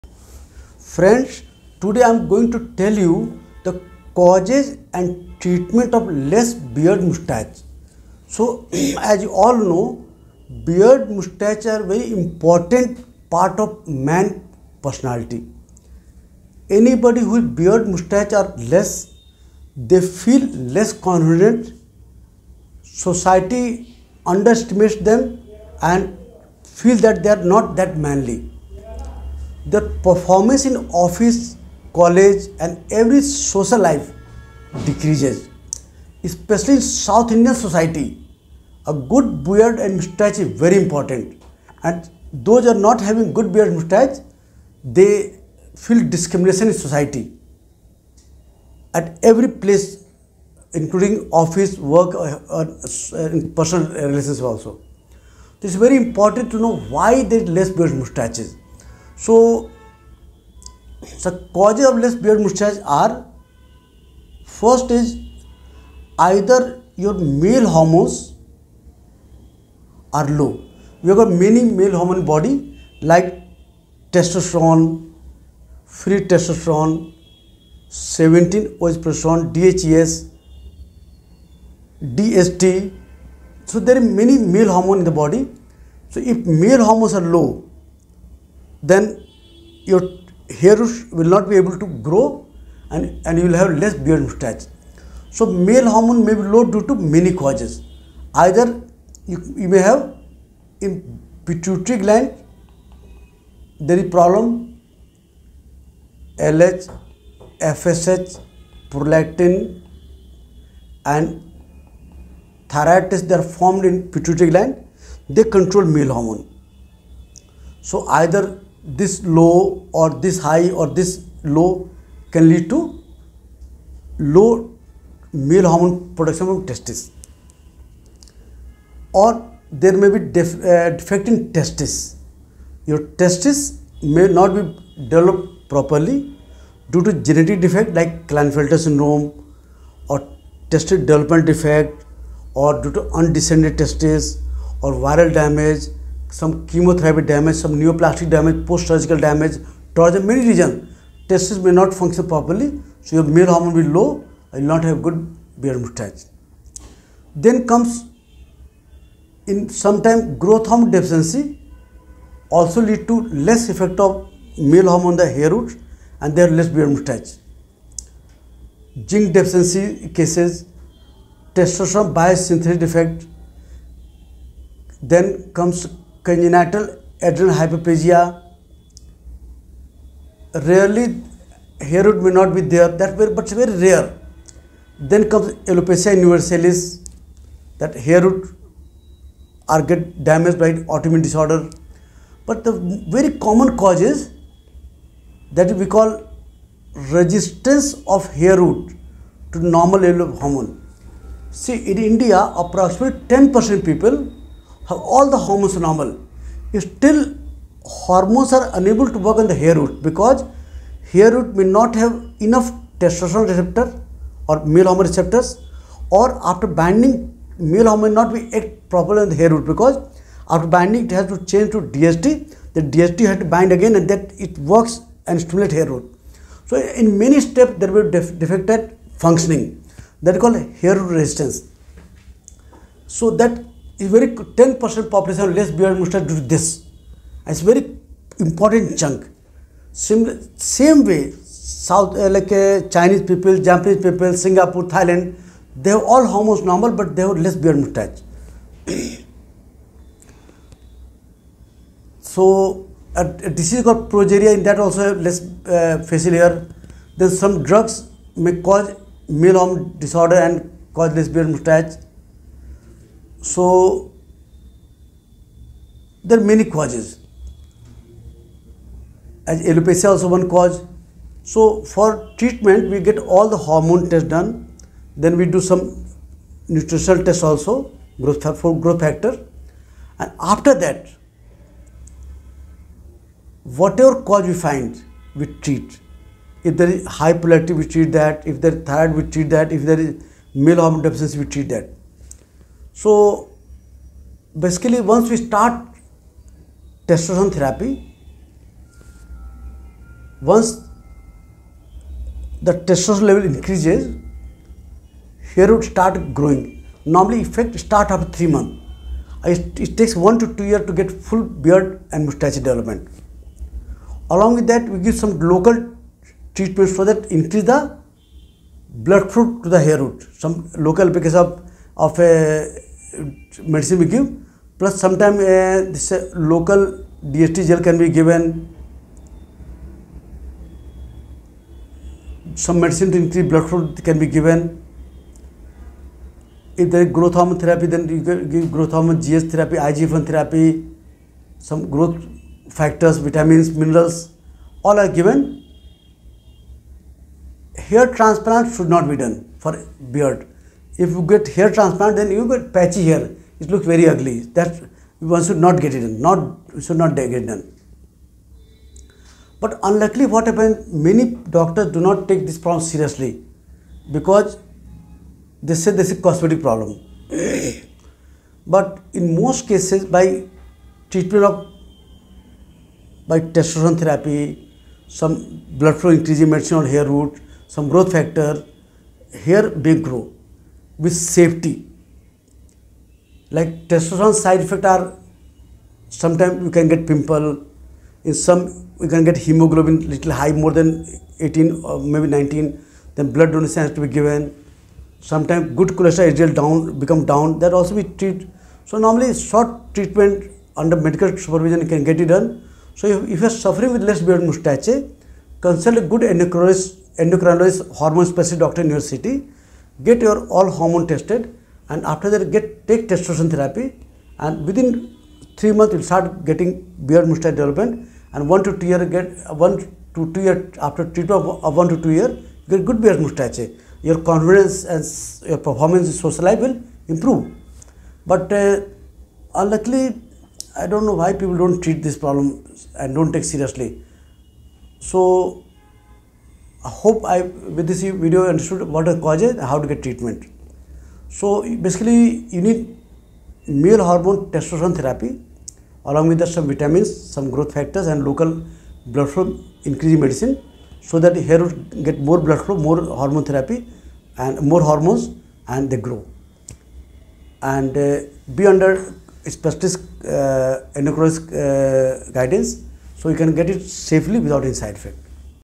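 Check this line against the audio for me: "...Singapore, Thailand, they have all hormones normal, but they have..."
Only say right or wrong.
right.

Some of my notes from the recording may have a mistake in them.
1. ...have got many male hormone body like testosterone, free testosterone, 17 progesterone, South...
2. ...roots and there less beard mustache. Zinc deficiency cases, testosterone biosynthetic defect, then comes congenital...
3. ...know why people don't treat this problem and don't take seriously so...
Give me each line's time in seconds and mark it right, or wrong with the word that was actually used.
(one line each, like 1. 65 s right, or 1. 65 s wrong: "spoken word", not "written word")
1. 71 s wrong: "DHES", not "South"
2. 165 s right
3. 431 s right.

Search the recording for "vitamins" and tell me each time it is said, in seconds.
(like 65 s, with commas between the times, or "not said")
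343 s, 446 s.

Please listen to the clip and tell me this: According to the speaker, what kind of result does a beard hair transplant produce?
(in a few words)
Patchy hair.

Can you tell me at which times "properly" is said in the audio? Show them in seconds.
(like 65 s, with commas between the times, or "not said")
135 s, 152 s, 218 s.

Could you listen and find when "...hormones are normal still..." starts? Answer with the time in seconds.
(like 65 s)
205 s.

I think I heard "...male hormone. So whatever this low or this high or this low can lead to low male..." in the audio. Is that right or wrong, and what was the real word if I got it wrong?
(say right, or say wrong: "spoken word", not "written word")
wrong: "either", not "whatever".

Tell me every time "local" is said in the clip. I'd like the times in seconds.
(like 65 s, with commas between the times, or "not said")
315 s, 320 s, 326 s, 448 s.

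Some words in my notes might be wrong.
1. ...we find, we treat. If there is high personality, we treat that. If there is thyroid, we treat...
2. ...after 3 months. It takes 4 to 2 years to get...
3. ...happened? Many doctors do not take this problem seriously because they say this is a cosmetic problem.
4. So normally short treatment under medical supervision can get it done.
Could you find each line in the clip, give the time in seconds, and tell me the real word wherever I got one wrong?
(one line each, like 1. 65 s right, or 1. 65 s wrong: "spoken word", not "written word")
1. 284 s wrong: "polarity", not "personality"
2. 308 s wrong: "1", not "4"
3. 360 s right
4. 398 s right.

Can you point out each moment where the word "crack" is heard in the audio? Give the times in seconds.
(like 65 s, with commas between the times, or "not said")
not said.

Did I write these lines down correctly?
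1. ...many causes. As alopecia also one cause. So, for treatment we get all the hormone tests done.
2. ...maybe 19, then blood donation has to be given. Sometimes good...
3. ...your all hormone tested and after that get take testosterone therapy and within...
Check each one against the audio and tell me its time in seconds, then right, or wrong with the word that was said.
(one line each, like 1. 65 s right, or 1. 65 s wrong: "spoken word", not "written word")
1. 266 s right
2. 391 s right
3. 410 s right.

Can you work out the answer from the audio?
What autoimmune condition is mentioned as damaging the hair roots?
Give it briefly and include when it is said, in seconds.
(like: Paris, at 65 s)
Alopecia universalis, at 185 s.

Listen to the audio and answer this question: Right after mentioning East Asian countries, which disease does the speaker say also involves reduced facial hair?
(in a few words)
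Progeria.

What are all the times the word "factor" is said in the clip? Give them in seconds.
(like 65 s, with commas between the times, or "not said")
278 s, 342 s, 378 s, 447 s.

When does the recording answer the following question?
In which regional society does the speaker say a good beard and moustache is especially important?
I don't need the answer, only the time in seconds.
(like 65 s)
36 s.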